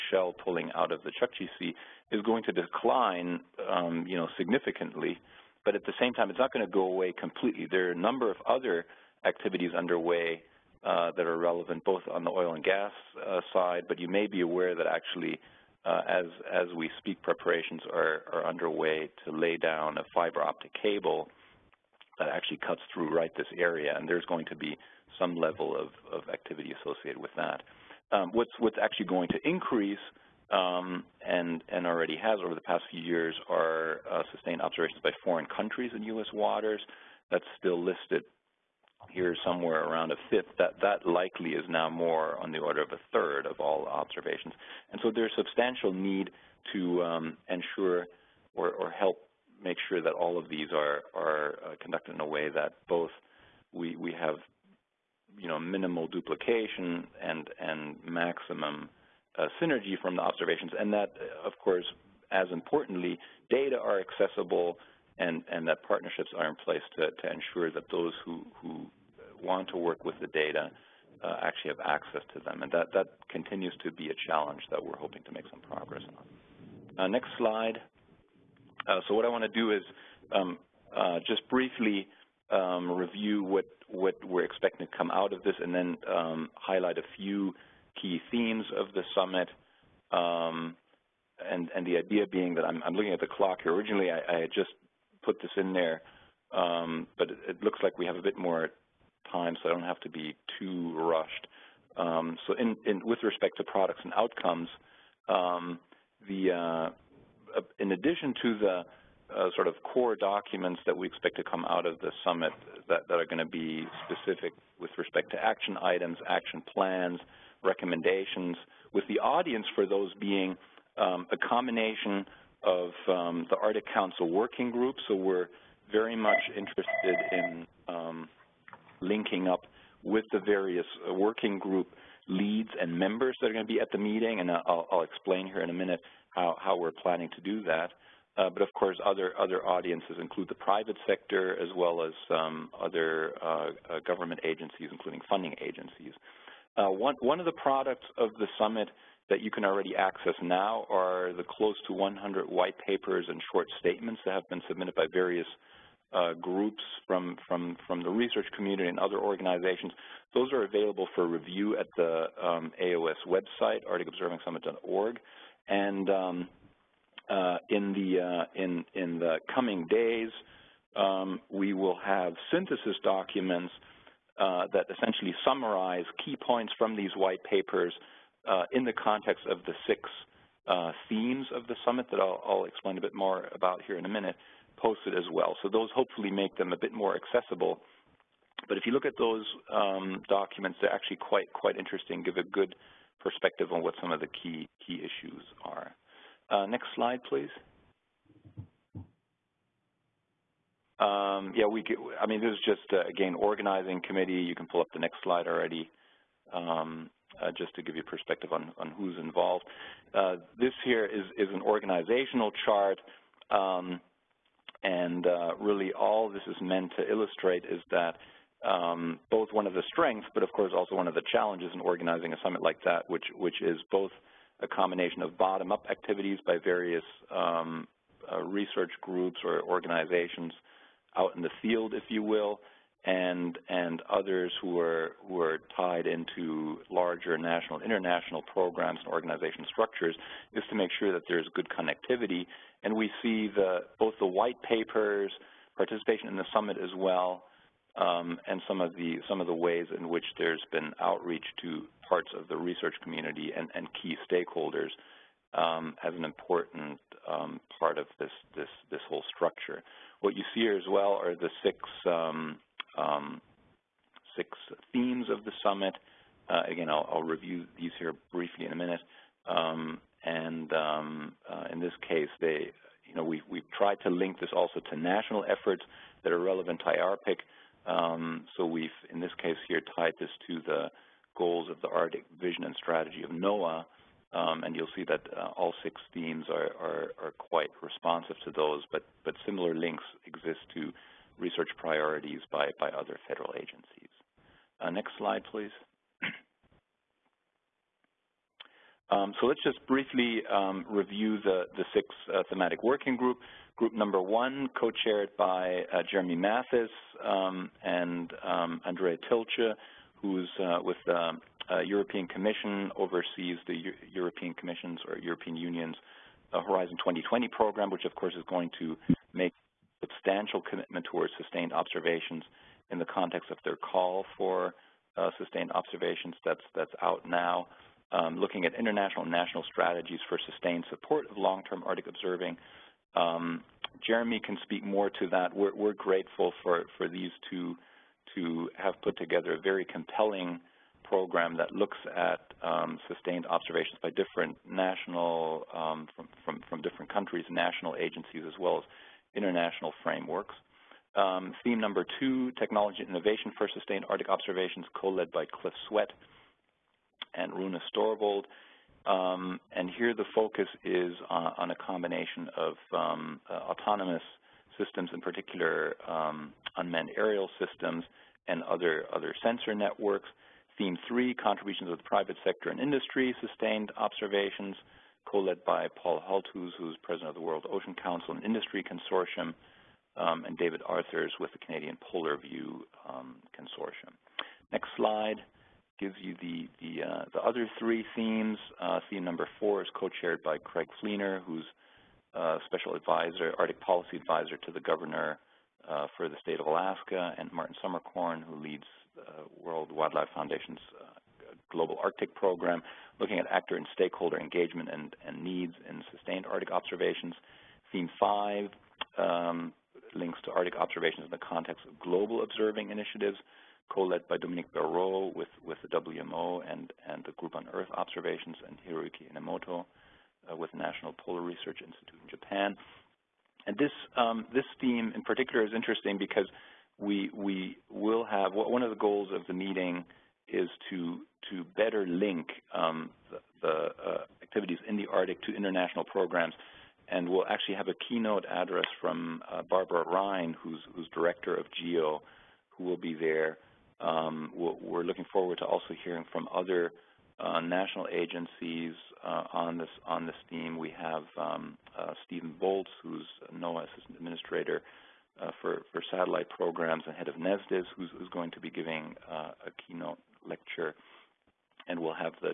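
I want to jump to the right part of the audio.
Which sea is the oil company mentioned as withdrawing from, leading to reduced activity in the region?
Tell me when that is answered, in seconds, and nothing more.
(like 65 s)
1 s.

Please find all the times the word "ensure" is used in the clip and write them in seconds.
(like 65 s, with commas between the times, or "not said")
47 s, 67 s.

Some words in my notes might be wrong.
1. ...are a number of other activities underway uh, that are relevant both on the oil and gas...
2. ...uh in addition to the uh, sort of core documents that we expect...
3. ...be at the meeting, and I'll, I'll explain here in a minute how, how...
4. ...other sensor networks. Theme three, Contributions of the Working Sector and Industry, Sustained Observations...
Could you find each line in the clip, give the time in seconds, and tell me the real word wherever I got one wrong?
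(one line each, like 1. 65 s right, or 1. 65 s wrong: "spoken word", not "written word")
1. 7 s right
2. 107 s right
3. 133 s right
4. 369 s wrong: "Private", not "Working".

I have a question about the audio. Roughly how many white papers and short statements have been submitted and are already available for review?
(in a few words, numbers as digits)
close to 100.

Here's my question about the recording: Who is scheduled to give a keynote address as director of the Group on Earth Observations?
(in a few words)
Barbara Ryan.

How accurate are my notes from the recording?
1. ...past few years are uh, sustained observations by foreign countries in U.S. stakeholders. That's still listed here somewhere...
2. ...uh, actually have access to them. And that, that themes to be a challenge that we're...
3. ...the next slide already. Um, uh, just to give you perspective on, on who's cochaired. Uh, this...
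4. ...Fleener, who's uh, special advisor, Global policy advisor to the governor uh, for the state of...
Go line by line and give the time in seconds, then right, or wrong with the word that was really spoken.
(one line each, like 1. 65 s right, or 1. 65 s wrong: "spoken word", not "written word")
1. 32 s wrong: "waters", not "stakeholders"
2. 71 s wrong: "continues", not "themes"
3. 204 s wrong: "involved", not "cochaired"
4. 391 s wrong: "Arctic", not "Global".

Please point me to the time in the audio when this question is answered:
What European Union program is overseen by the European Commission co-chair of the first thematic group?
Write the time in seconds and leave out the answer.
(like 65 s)
316 s.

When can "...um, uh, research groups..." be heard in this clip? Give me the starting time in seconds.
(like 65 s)
227 s.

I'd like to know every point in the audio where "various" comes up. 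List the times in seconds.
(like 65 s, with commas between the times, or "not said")
130 s, 155 s, 226 s.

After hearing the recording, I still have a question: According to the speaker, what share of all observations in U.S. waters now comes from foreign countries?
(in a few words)
a third.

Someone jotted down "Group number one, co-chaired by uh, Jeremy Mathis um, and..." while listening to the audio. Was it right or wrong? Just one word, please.
right.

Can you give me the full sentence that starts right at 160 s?
Those are available for review at the um, AOS website, arcticobservingsummit.org.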